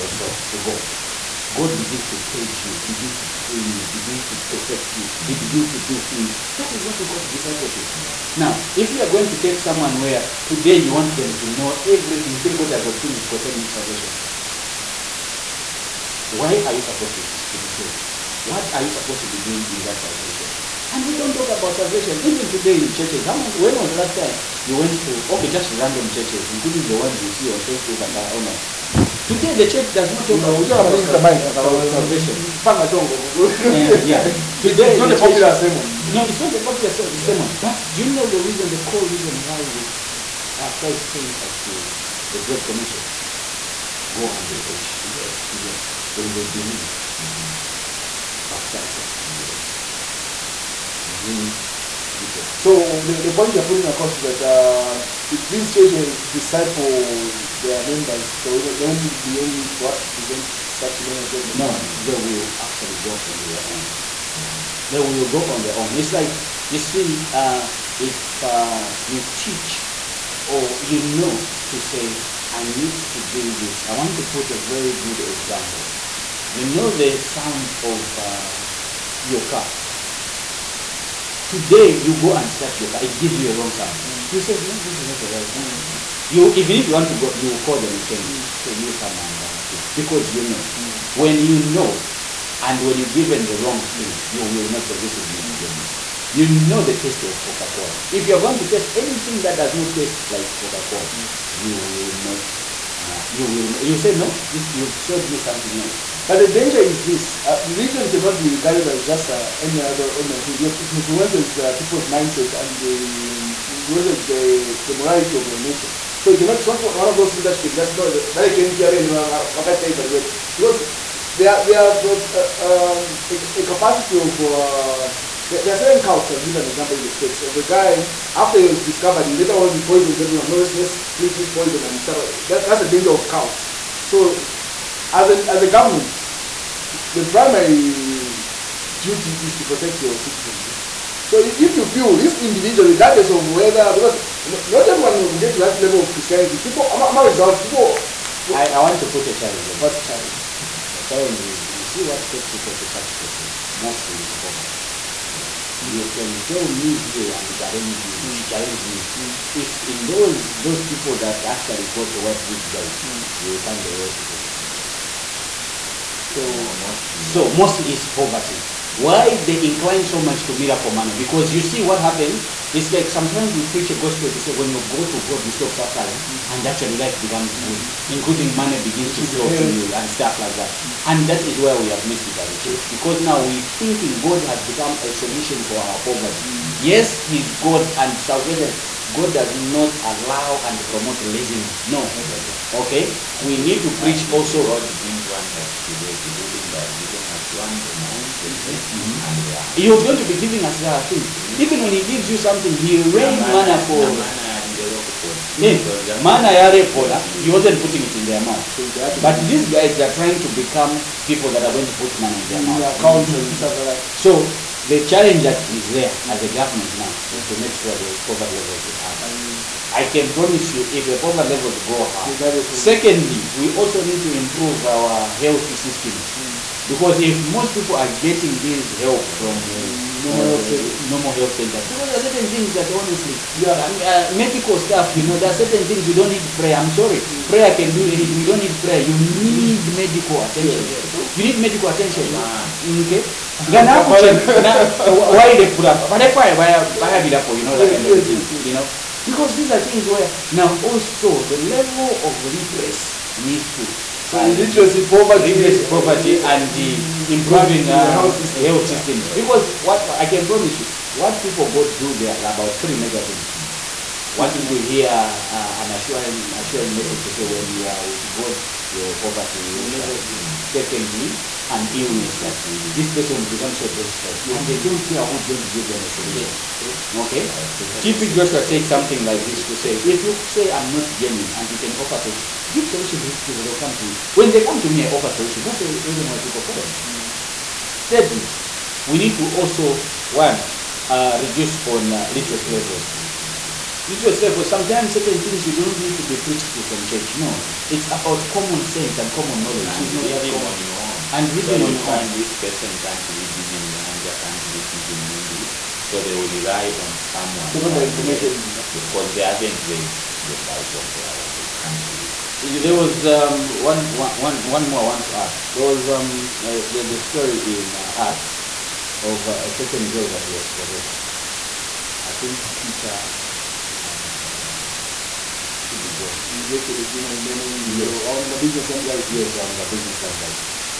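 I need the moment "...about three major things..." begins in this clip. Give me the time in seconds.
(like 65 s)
262 s.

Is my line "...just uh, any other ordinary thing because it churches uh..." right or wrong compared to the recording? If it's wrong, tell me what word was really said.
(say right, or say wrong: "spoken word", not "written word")
wrong: "influences", not "churches".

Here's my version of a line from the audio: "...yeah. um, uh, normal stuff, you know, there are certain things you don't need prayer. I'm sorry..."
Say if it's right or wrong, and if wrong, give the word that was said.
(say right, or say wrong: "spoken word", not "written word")
wrong: "medical", not "normal".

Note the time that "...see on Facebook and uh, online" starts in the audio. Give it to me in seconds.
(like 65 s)
27 s.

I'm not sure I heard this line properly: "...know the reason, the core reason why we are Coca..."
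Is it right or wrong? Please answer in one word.
wrong.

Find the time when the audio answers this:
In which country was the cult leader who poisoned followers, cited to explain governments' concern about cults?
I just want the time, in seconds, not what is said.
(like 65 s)
127 s.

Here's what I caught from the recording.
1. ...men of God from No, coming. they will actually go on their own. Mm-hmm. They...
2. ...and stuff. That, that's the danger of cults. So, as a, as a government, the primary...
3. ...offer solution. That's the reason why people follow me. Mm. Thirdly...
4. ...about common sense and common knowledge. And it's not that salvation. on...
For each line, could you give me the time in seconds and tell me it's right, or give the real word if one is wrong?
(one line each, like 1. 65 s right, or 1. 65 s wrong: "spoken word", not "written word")
1. 61 s right
2. 131 s right
3. 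285 s right
4. 298 s wrong: "common", not "salvation".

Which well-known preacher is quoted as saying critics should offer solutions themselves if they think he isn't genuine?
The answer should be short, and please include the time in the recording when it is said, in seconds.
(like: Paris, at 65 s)
TB Joshua, at 277 s.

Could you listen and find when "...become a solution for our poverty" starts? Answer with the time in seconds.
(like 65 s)
184 s.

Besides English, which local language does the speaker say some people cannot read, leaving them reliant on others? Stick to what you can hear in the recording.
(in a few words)
Nyanja.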